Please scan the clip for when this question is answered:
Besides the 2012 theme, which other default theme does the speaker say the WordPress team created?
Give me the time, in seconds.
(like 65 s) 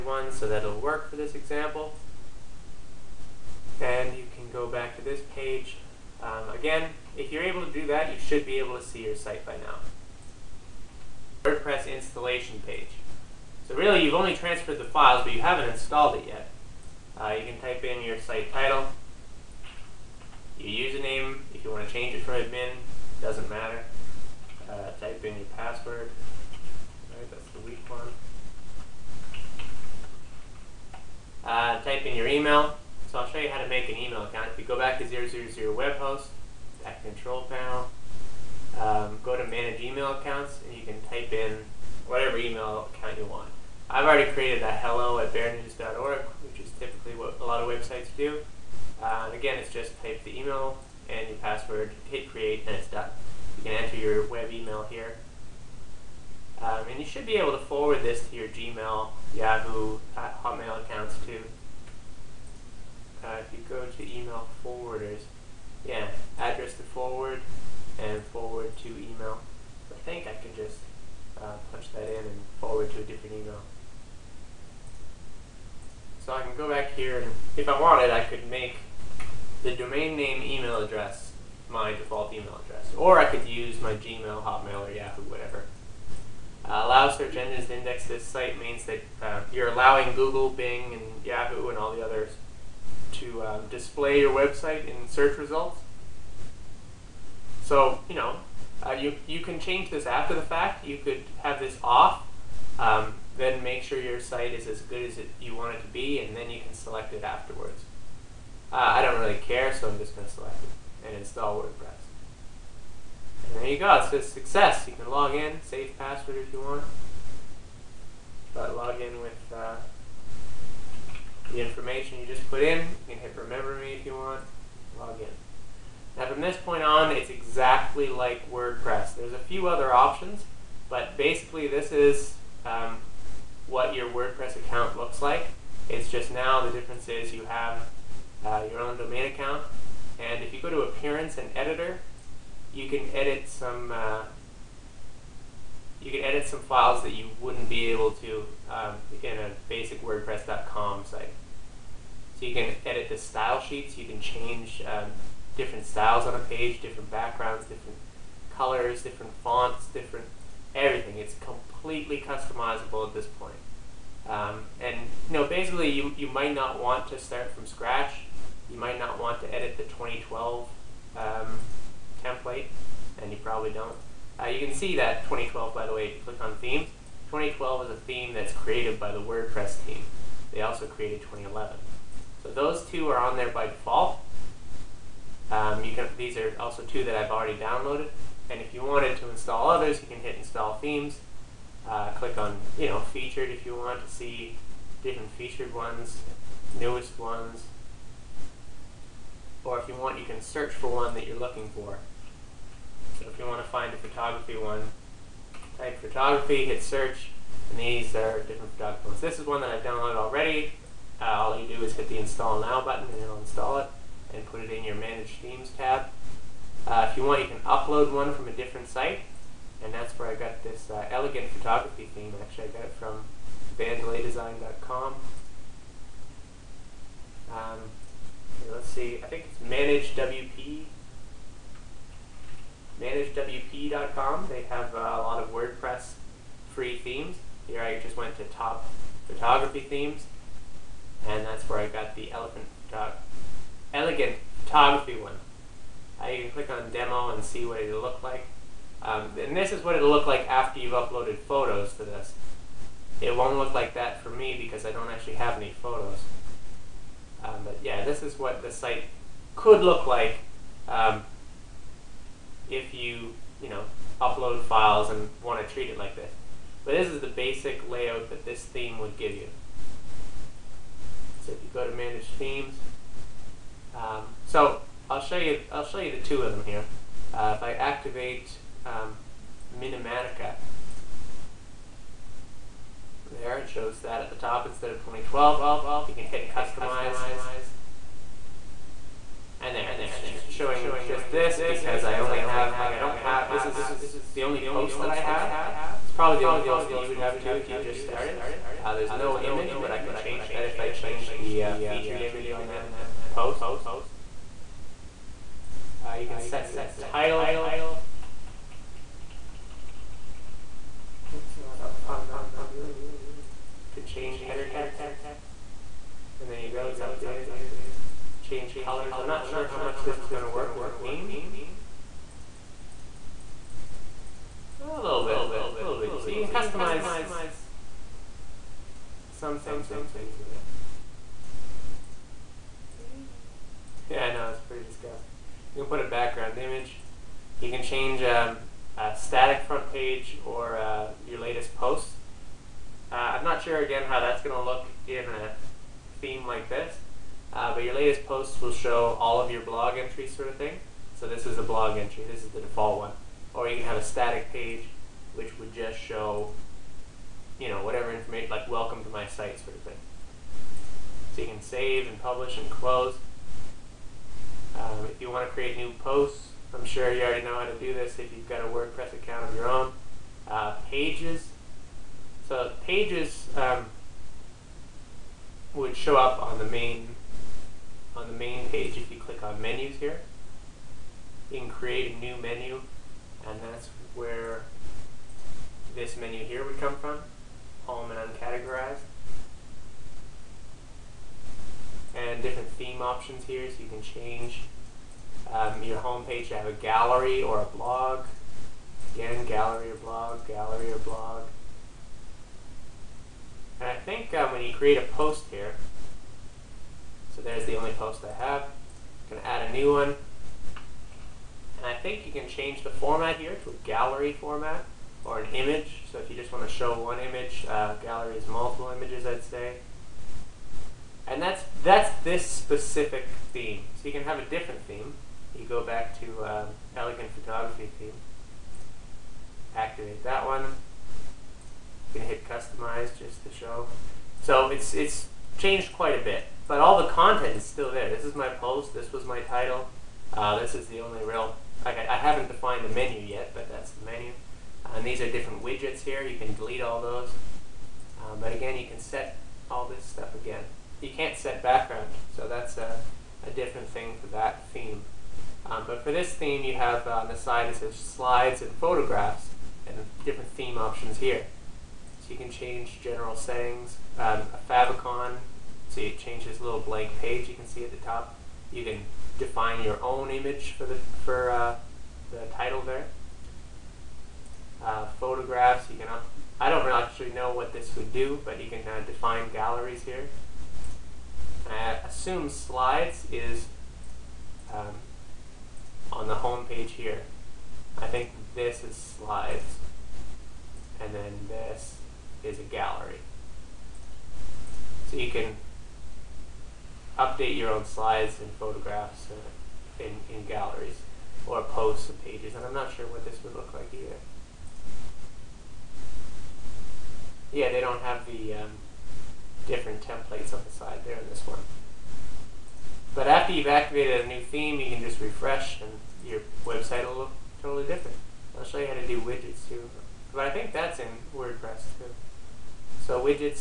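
181 s.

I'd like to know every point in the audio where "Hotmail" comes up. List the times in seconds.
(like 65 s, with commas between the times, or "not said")
60 s, 84 s.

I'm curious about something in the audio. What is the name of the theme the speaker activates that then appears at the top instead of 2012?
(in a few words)
Minimatica.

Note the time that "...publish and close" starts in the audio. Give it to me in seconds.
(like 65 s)
362 s.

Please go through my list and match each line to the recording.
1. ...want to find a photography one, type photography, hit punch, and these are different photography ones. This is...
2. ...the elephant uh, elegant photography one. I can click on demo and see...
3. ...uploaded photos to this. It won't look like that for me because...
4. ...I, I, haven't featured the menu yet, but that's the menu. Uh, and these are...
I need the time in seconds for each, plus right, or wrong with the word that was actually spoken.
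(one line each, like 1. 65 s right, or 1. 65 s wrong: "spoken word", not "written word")
1. 203 s wrong: "search", not "punch"
2. 242 s right
3. 250 s right
4. 441 s wrong: "defined", not "featured".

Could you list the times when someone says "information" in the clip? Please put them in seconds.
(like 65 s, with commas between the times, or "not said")
121 s, 358 s.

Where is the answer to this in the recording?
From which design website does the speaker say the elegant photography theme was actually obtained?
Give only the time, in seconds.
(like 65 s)
223 s.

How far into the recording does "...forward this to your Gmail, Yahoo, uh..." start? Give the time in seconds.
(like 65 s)
57 s.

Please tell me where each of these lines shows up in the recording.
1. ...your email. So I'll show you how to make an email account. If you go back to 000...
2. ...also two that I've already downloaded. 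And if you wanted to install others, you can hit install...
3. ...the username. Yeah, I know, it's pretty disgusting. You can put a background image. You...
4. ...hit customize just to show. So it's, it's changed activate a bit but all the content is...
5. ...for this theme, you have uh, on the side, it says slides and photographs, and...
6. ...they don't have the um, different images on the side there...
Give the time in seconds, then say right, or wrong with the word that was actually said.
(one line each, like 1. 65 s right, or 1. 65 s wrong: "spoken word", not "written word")
1. 32 s right
2. 186 s right
3. 330 s wrong: "theme", not "username"
4. 432 s wrong: "quite", not "activate"
5. 456 s right
6. 507 s wrong: "templates", not "images".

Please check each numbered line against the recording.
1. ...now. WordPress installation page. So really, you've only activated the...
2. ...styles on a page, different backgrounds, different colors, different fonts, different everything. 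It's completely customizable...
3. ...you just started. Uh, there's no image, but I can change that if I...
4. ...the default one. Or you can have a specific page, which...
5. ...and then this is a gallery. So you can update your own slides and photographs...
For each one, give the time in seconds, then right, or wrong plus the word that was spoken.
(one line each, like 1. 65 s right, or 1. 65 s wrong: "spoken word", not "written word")
1. 9 s wrong: "transferred", not "activated"
2. 155 s right
3. 297 s right
4. 352 s wrong: "static", not "specific"
5. 491 s right.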